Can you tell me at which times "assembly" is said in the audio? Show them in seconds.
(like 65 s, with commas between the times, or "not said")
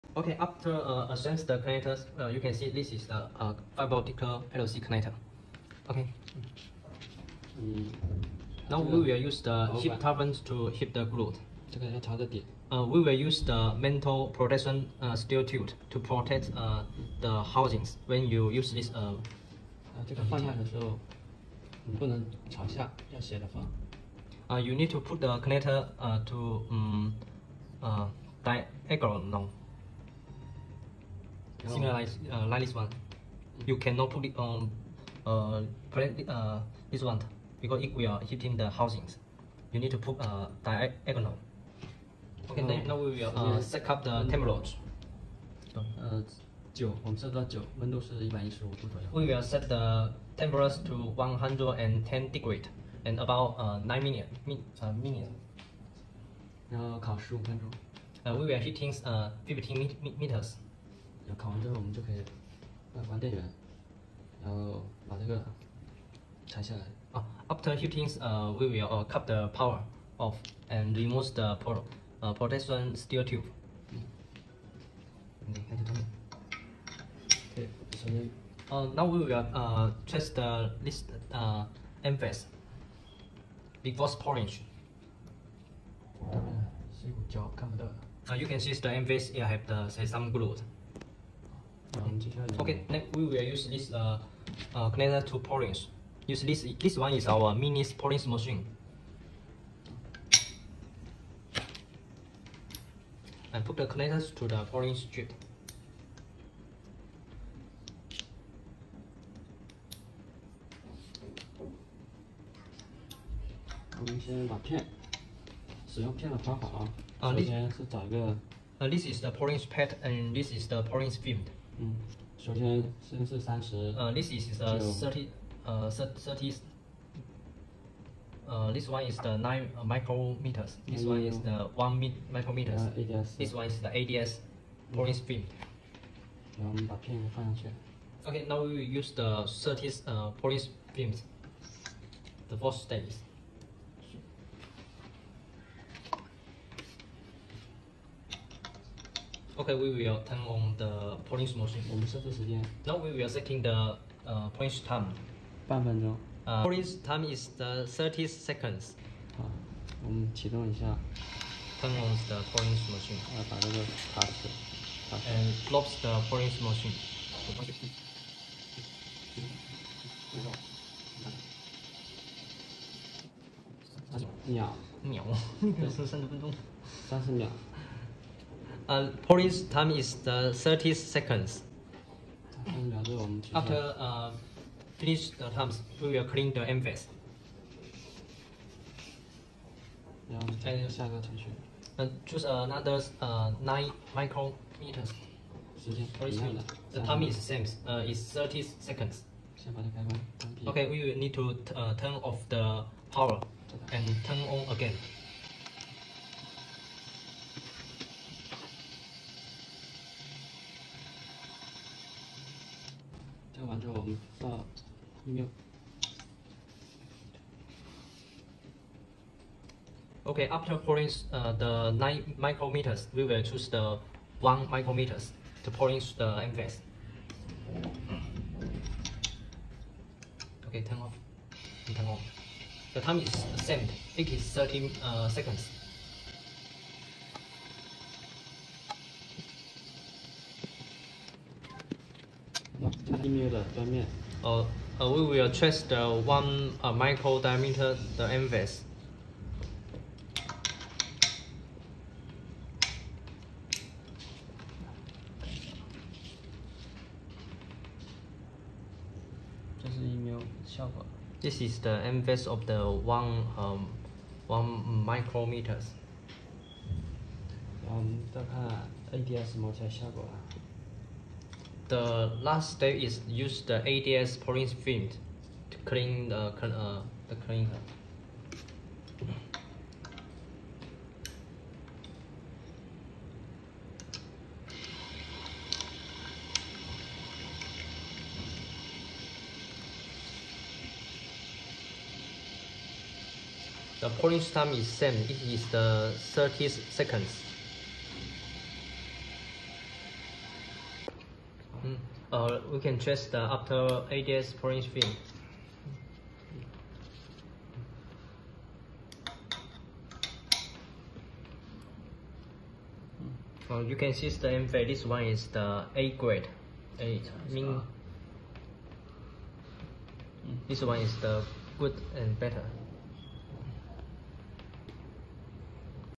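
1 s.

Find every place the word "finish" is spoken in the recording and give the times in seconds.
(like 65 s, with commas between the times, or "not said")
184 s.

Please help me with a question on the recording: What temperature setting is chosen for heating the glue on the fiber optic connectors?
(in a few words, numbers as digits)
110 degrees.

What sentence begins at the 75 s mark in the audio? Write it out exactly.
你 看 这 东 西。 对， 首 先。 Uh, now we will uh test the list uh emphasis before pouring.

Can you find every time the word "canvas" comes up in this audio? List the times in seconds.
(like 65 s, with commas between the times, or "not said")
186 s, 248 s, 262 s.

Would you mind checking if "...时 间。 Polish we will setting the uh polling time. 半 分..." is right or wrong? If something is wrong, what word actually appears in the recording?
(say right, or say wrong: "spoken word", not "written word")
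wrong: "Now", not "Polish".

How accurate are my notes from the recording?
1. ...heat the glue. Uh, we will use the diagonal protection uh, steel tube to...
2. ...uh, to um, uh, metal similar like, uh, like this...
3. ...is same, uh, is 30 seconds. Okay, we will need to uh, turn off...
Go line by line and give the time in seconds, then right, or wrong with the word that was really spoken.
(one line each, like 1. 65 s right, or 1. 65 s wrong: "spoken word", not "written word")
1. 10 s wrong: "metal", not "diagonal"
2. 25 s wrong: "diagonal", not "metal"
3. 197 s right.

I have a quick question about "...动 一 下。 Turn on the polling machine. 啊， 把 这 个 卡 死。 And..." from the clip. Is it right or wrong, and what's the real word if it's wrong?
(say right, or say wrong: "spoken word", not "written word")
right.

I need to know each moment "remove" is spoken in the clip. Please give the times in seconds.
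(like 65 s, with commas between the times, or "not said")
70 s.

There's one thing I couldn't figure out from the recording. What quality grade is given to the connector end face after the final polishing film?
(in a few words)
A grade.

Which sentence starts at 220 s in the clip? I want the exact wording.
Okay, after pouring uh, the nine micrometers we will choose the one micrometers to pouring the MVS.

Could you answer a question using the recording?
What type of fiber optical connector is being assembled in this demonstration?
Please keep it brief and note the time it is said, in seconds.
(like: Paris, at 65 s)
LC connector, at 4 s.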